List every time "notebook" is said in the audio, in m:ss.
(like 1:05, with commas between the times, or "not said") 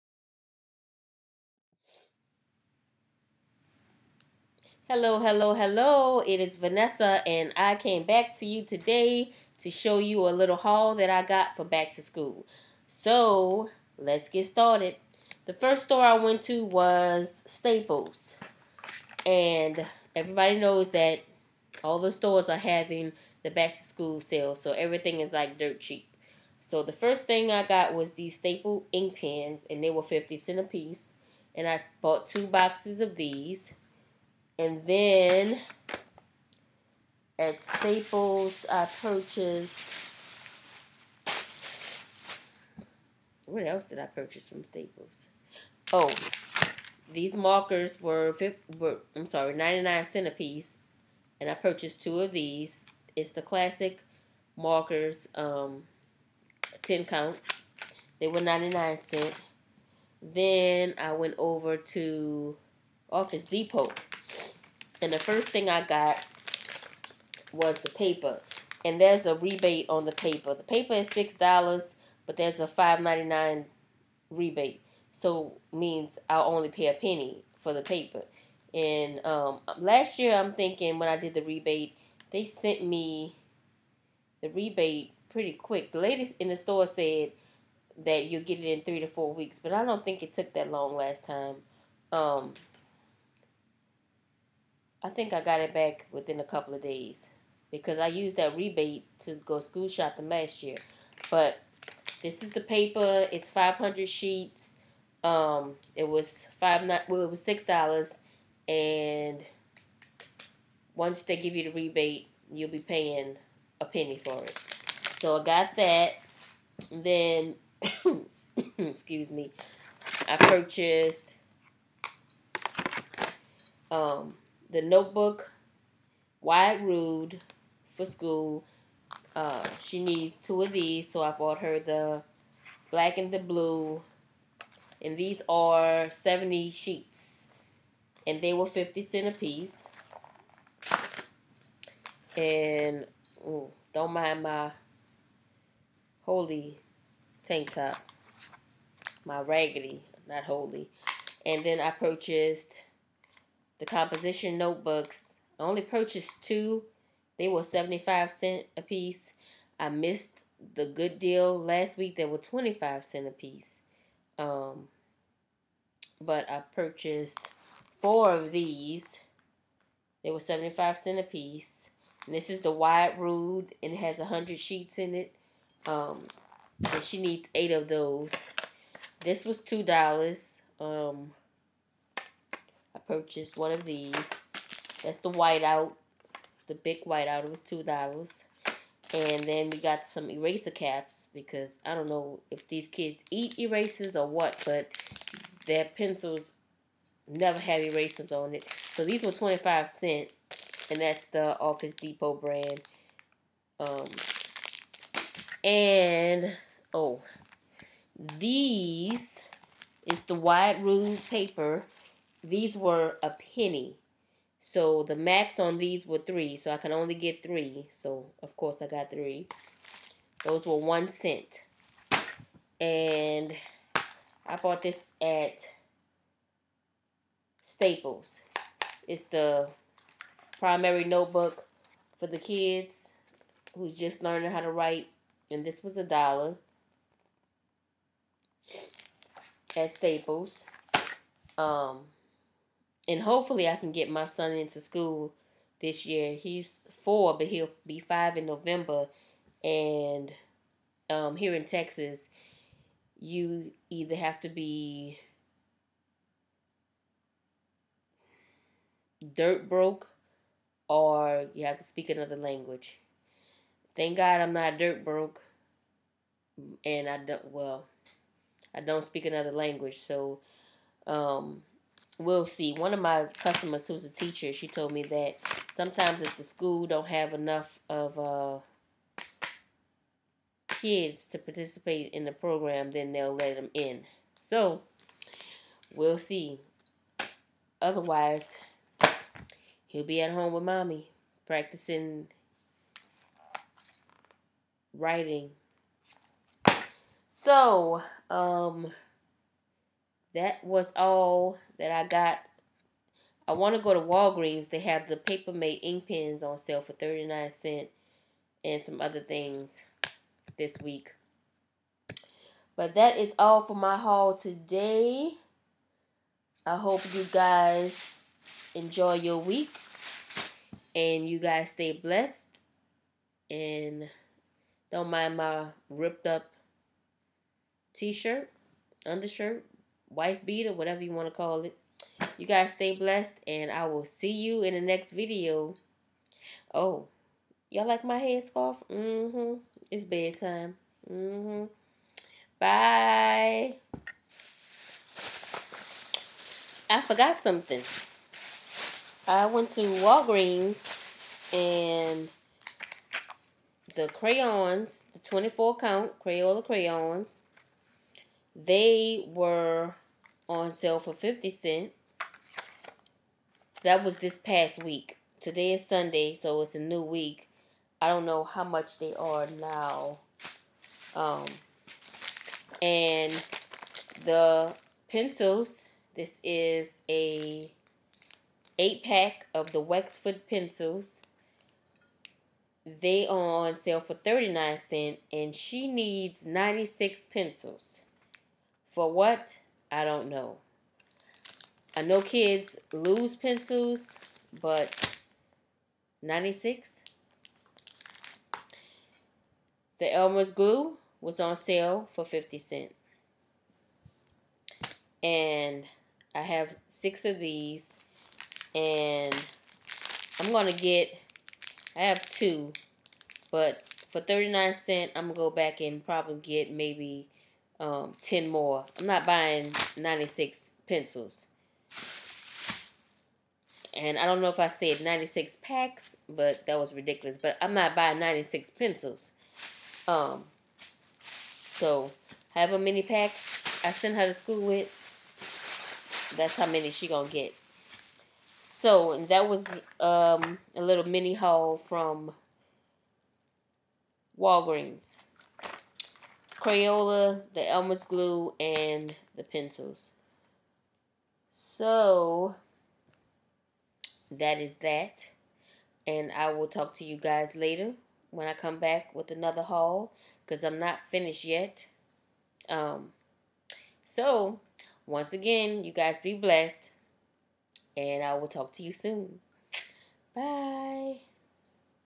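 2:04, 2:34, 3:51.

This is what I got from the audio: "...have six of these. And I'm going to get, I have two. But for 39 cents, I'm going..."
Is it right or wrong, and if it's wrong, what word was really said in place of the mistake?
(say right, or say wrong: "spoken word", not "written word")
right.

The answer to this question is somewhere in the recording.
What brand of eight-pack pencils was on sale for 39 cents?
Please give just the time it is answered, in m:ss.
6:19.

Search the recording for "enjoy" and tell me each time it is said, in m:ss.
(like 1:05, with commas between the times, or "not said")
5:18.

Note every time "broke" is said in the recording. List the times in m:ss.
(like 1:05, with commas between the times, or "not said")
4:19, 4:25.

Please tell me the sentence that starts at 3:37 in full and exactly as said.
So of course I got three.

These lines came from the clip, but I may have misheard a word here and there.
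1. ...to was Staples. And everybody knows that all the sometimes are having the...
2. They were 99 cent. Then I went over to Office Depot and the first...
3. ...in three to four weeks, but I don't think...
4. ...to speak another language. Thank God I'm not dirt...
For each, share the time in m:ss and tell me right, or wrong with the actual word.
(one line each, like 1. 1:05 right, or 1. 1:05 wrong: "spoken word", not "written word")
1. 0:16 wrong: "stores", not "sometimes"
2. 0:58 right
3. 1:28 right
4. 4:21 right.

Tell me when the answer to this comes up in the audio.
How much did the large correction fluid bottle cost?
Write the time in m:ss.
3:07.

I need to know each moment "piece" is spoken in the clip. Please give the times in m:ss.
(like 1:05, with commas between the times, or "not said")
0:30, 0:50, 2:19, 2:38, 2:43, 2:51.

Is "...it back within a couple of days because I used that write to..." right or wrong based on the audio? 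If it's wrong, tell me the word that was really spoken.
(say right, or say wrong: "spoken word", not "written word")
wrong: "rebate", not "write".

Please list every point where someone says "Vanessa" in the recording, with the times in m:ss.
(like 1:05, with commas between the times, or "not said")
0:06.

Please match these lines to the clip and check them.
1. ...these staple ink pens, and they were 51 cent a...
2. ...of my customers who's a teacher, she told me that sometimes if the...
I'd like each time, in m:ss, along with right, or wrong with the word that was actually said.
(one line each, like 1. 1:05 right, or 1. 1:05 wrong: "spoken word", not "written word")
1. 0:28 wrong: "50", not "51"
2. 4:32 right.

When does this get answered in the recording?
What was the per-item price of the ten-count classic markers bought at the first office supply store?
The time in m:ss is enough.
0:49.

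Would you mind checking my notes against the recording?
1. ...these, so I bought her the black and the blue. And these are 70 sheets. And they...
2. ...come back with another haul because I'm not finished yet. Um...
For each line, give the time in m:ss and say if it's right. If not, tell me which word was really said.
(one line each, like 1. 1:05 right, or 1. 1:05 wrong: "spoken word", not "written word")
1. 2:10 right
2. 7:38 right.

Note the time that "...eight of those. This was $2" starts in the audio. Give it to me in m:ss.
2:57.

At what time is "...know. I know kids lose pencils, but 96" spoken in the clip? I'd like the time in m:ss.
6:30.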